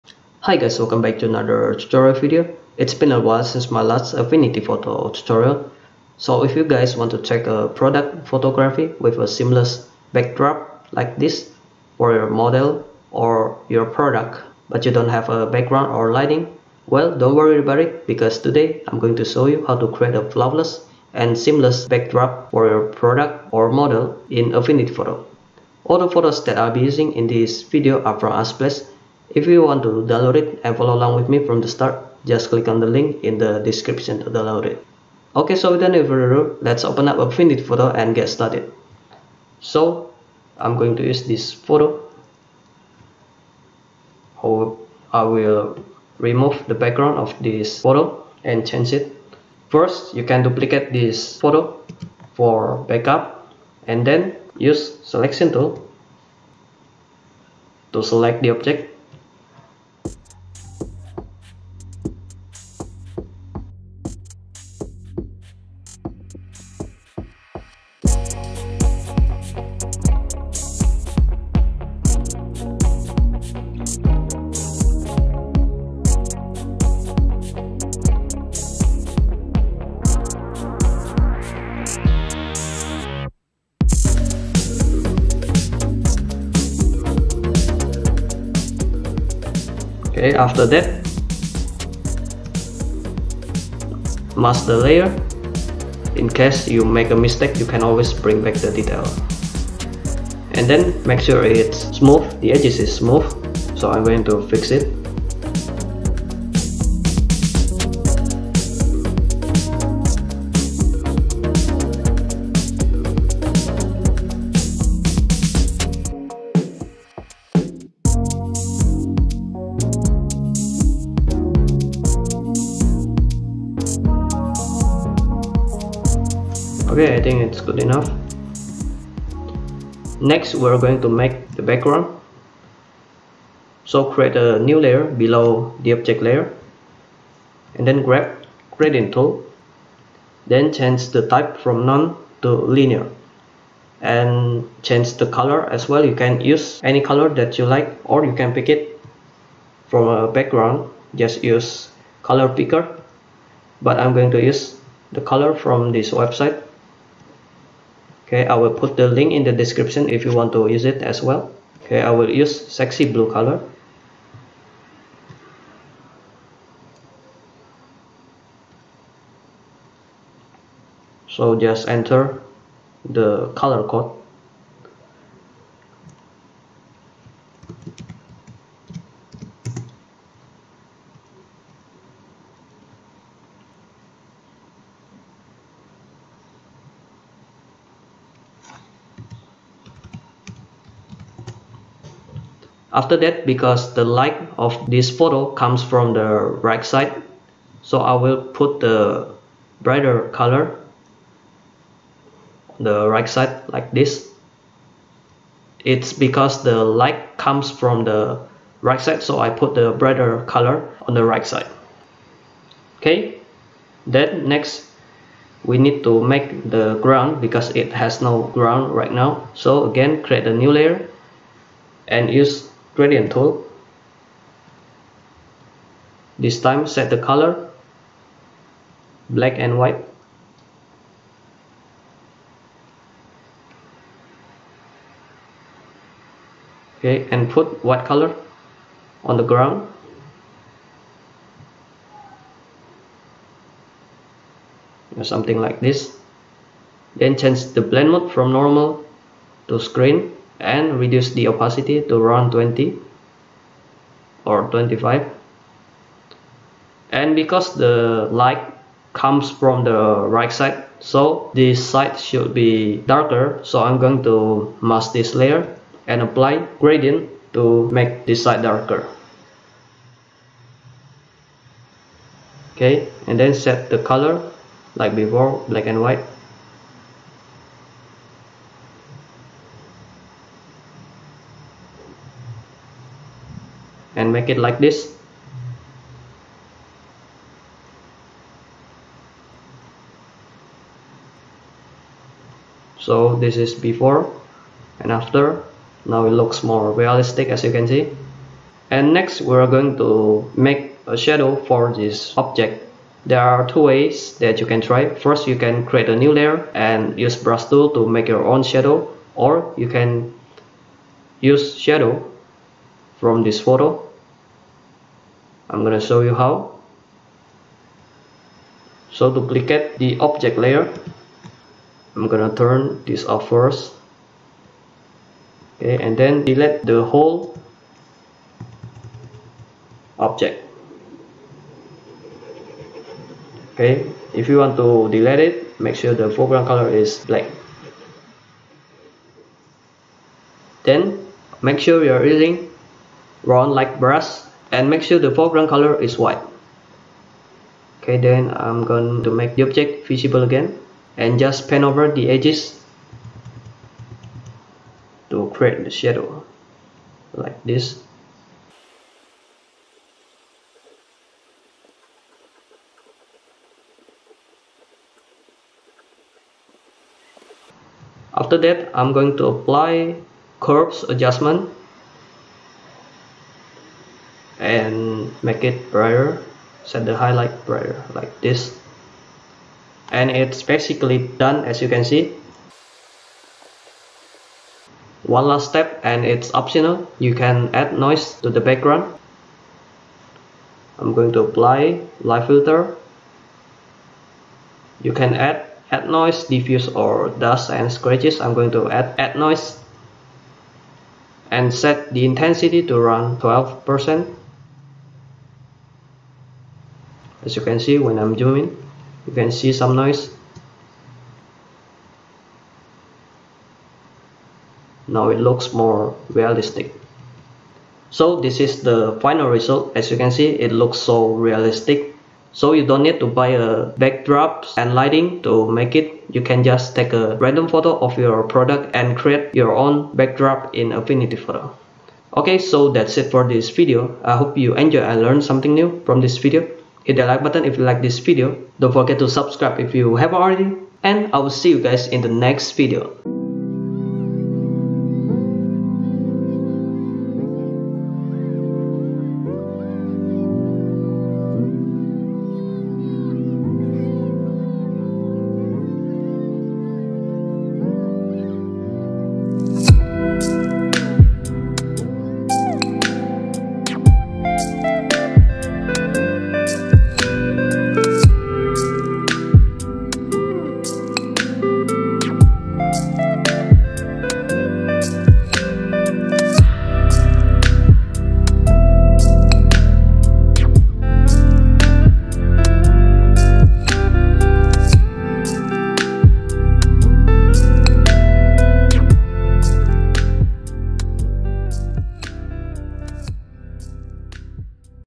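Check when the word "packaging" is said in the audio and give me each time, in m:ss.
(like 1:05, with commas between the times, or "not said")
not said.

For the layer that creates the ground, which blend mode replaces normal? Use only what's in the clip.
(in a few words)
Screen.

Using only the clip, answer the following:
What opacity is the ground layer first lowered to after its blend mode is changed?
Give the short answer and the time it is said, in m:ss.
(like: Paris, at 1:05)
20, at 4:12.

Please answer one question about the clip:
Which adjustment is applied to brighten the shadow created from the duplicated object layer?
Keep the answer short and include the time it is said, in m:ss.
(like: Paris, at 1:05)
Curves, at 6:10.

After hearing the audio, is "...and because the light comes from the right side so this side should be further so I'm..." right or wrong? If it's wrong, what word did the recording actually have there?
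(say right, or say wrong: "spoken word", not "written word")
wrong: "darker", not "further".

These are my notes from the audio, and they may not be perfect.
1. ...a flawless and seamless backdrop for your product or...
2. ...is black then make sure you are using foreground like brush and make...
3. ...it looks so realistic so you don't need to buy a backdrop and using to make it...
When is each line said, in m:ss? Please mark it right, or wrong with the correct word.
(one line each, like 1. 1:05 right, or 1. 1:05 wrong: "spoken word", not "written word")
1. 0:20 right
2. 5:36 wrong: "round", not "foreground"
3. 7:00 wrong: "lighting", not "using".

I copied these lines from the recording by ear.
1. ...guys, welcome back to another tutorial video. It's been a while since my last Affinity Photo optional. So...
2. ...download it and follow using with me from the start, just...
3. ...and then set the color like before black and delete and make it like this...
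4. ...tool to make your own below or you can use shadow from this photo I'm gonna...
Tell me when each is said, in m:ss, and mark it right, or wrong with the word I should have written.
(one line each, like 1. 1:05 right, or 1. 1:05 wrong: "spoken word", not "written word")
1. 0:00 wrong: "tutorial", not "optional"
2. 0:30 wrong: "along", not "using"
3. 4:33 wrong: "white", not "delete"
4. 5:07 wrong: "shadow", not "below".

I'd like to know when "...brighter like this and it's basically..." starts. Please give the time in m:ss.
6:17.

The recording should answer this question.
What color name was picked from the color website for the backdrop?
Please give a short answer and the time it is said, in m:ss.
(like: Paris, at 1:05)
Sexy blue, at 2:42.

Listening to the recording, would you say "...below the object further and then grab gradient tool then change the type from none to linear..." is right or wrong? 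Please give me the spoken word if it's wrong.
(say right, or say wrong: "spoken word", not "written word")
wrong: "layer", not "further".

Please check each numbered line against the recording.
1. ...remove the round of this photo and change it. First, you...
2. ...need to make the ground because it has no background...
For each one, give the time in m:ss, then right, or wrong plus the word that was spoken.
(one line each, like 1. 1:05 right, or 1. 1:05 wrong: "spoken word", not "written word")
1. 0:46 wrong: "background", not "round"
2. 3:35 wrong: "ground", not "background".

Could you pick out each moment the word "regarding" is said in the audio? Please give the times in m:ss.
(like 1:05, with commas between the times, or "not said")
not said.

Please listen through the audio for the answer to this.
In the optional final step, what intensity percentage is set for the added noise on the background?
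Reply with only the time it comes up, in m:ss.
6:43.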